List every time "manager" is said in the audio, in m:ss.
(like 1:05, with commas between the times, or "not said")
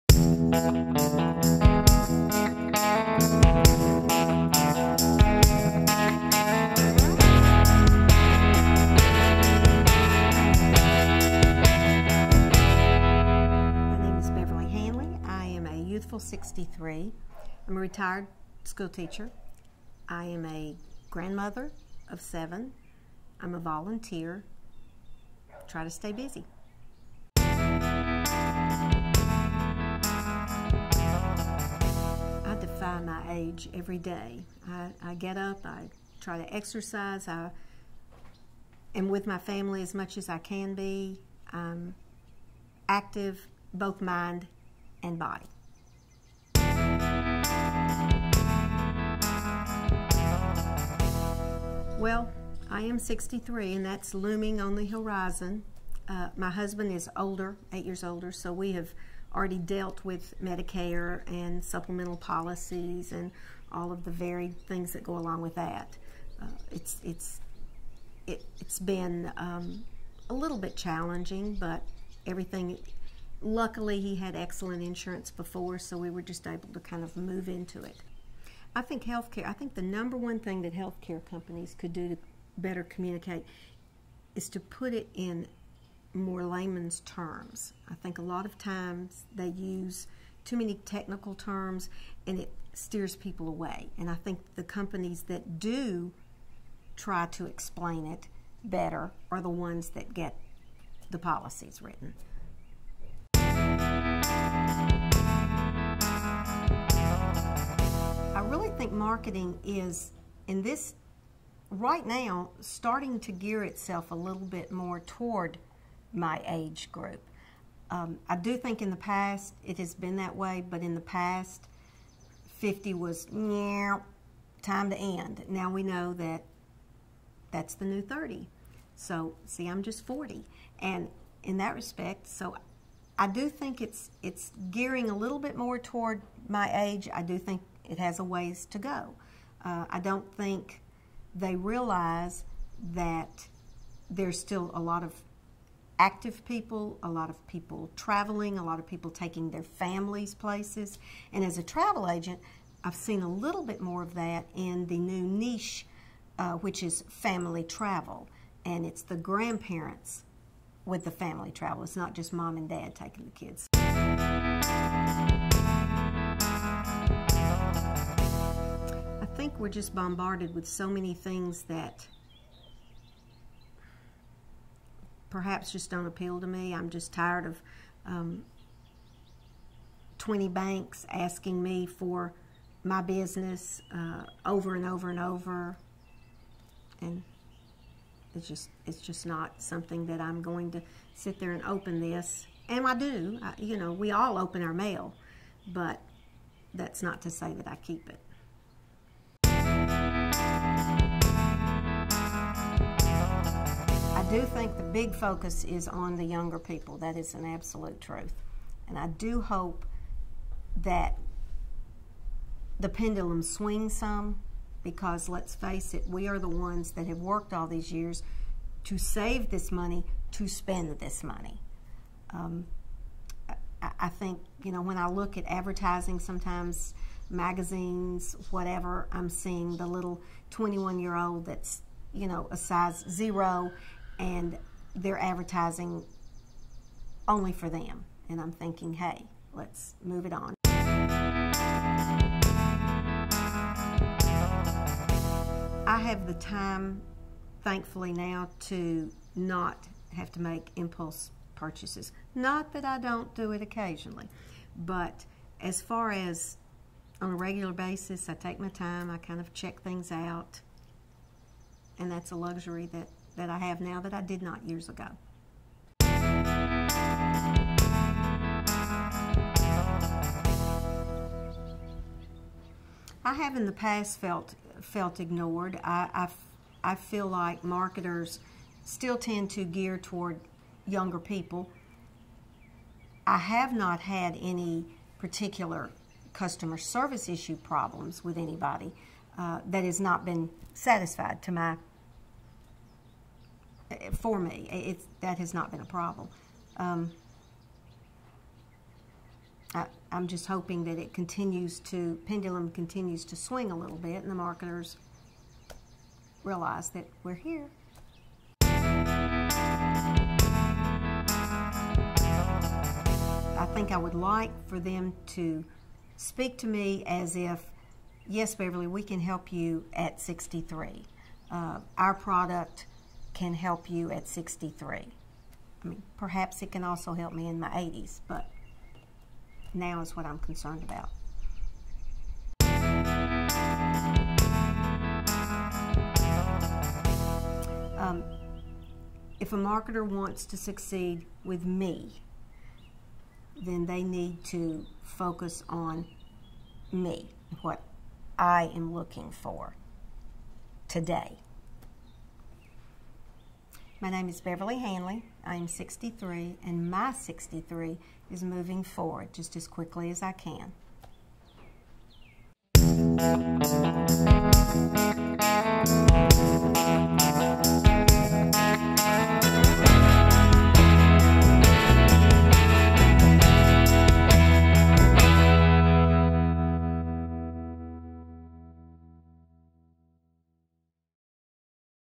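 not said.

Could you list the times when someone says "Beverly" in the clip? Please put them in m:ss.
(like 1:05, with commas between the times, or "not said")
5:18, 5:54.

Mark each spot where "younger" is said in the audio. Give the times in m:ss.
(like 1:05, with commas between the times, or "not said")
3:26, 4:40.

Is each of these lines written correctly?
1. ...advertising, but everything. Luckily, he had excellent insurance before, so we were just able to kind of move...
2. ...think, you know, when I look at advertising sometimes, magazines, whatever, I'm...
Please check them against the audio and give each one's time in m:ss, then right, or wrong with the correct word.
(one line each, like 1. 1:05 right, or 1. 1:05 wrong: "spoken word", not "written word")
1. 1:10 wrong: "challenging", not "advertising"
2. 3:44 right.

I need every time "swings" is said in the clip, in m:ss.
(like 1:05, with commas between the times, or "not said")
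3:33, 5:03.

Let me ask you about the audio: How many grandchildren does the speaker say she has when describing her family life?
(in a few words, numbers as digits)
7.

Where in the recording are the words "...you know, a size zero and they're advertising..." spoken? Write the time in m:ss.
3:52.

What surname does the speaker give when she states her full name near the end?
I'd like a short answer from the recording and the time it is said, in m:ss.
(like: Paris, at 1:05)
Hanley, at 5:54.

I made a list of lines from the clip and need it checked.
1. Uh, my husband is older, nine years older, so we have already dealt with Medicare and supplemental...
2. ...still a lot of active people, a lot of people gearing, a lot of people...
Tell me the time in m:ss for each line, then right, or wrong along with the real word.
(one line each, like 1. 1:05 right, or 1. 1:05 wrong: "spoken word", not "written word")
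1. 0:56 wrong: "eight", not "nine"
2. 2:24 wrong: "traveling", not "gearing".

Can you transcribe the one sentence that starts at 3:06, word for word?
And it's just, it's just not something that I'm going to sit there and open this.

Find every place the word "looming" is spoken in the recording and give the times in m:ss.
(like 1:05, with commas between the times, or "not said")
0:54.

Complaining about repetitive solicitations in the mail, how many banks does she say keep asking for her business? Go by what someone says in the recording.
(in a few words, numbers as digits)
20.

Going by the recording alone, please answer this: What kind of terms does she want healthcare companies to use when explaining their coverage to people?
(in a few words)
layman's terms.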